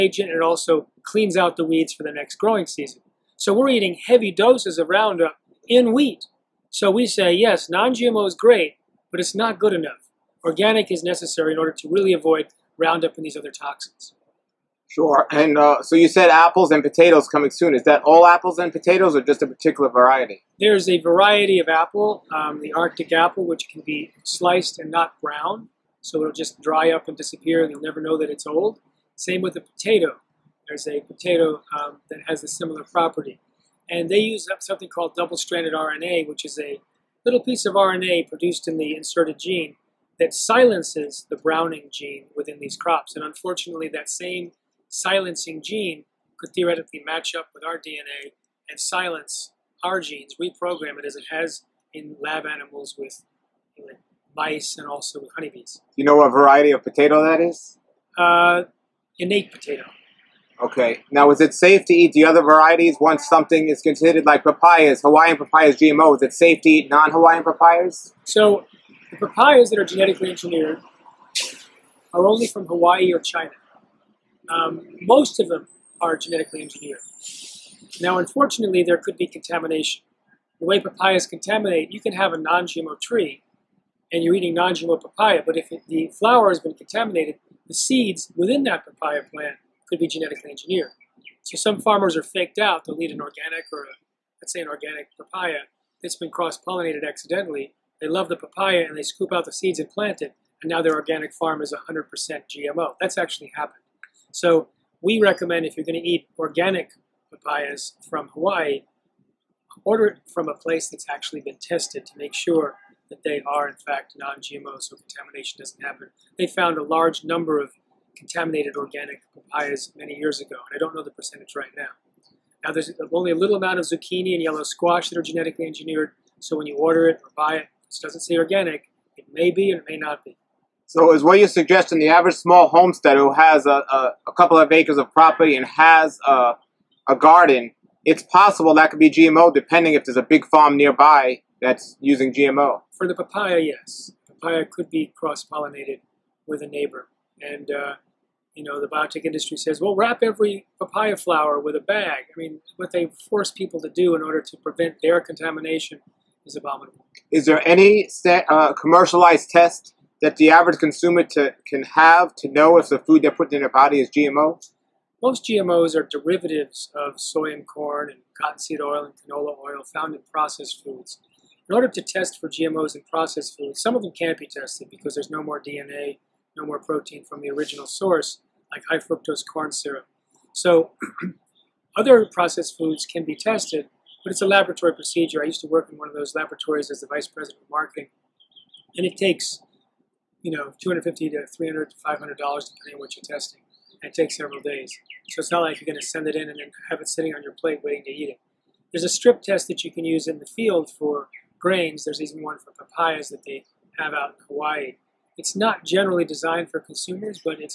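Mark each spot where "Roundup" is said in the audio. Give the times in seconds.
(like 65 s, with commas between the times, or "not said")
4 s, 12 s.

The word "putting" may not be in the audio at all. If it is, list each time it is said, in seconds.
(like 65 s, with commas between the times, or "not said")
163 s.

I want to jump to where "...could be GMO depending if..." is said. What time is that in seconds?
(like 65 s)
138 s.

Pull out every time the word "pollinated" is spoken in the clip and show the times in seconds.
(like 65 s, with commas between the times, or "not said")
96 s, 145 s.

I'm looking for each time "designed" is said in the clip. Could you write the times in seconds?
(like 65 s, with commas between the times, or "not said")
206 s.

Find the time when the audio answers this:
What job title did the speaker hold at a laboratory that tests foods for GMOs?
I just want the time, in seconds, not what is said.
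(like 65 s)
187 s.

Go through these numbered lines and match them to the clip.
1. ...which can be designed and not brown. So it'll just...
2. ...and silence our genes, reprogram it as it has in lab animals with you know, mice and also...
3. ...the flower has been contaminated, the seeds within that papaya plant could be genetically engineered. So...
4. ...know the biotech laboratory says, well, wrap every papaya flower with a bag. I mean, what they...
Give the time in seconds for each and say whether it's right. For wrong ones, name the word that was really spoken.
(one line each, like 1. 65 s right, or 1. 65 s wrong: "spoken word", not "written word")
1. 23 s wrong: "sliced", not "designed"
2. 48 s right
3. 85 s right
4. 148 s wrong: "industry", not "laboratory".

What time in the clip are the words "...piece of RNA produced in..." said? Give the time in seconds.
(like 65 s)
37 s.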